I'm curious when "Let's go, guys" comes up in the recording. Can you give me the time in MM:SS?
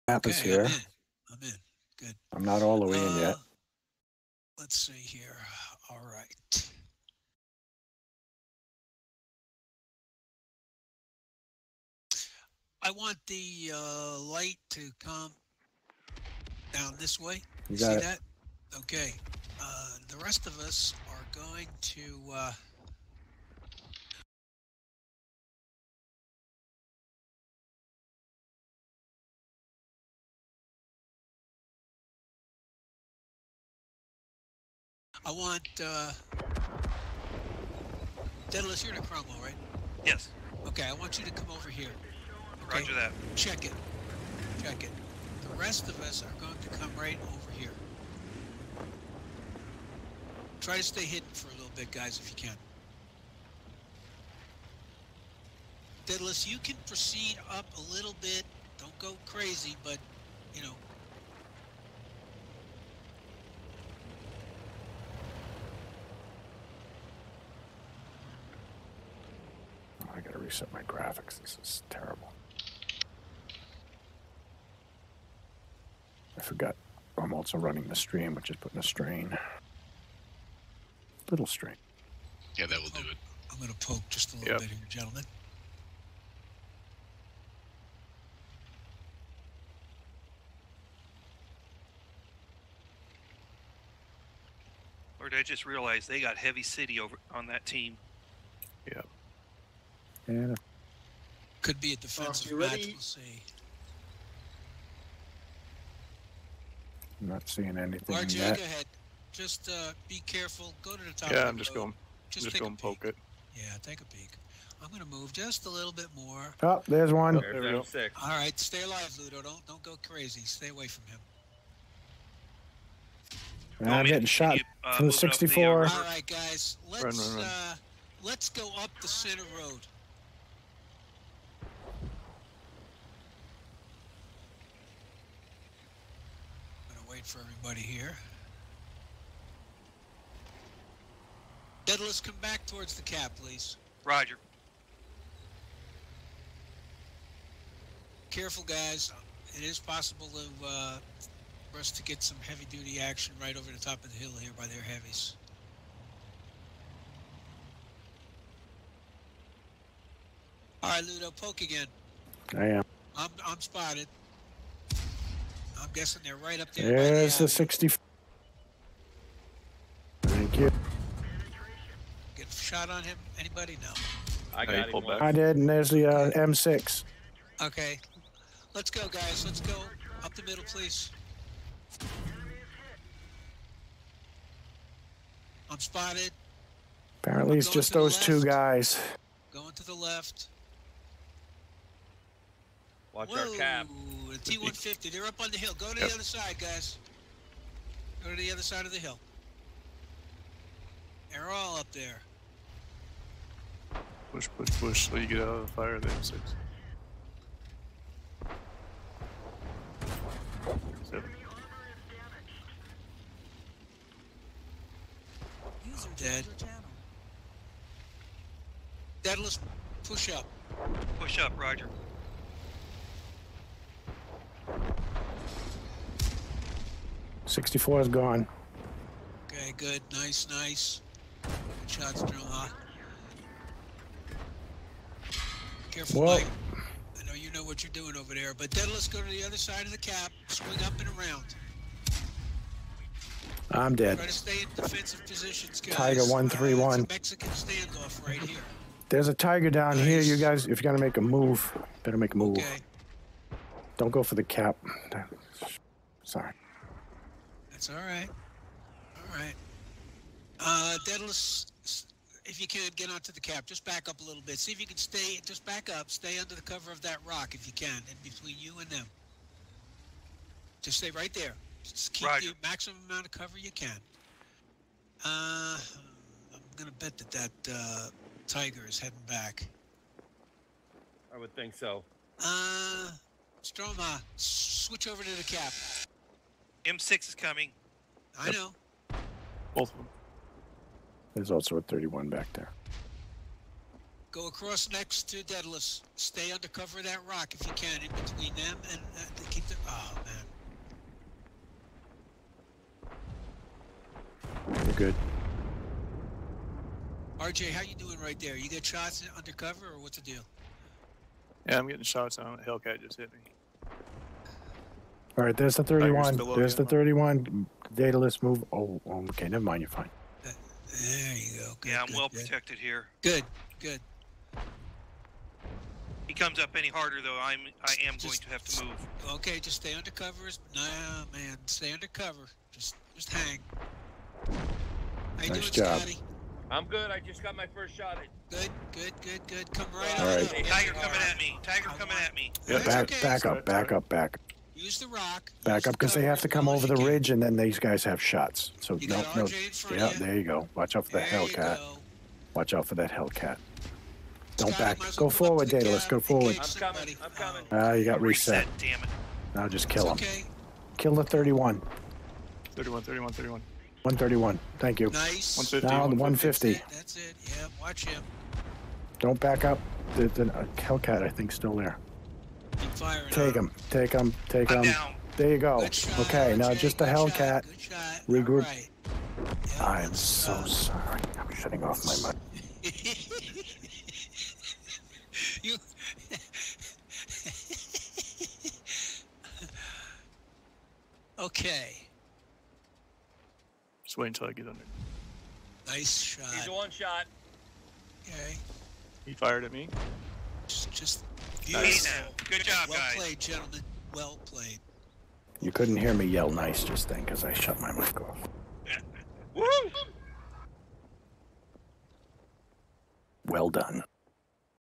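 02:58.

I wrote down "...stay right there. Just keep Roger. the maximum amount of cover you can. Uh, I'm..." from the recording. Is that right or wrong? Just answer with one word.
right.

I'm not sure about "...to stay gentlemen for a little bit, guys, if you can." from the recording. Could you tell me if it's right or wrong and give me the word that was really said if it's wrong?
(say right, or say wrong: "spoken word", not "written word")
wrong: "hidden", not "gentlemen".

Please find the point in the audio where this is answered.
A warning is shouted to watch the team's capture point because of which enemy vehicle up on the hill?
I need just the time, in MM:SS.
03:14.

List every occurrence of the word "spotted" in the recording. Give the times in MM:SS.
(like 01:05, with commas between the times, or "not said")
02:43, 03:05.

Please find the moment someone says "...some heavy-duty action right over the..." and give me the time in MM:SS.
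02:32.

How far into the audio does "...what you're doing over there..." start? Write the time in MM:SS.
03:57.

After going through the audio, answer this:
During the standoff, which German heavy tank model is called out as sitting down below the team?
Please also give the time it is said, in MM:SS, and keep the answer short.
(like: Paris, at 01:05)
Tiger 131, at 04:05.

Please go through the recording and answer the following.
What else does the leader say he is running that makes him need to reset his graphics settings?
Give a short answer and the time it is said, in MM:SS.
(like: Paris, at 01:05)
the stream, at 01:17.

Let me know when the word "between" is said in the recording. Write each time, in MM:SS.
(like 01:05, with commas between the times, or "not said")
04:28, 04:58.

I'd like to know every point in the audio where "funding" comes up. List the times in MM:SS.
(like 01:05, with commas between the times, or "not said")
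not said.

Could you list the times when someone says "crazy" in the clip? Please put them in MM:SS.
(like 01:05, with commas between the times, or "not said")
00:59, 02:00.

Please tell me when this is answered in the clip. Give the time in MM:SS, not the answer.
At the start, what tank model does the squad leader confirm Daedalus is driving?
00:39.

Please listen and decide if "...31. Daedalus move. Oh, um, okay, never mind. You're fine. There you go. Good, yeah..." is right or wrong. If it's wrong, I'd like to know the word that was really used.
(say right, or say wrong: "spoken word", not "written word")
right.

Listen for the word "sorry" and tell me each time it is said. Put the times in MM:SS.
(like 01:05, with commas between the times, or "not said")
04:16, 06:20.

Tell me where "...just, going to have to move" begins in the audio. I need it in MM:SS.
05:28.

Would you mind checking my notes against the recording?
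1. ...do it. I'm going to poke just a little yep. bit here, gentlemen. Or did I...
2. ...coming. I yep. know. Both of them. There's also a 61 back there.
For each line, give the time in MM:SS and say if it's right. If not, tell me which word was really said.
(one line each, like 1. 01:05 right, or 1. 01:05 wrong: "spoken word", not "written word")
1. 01:22 right
2. 04:47 wrong: "31", not "61".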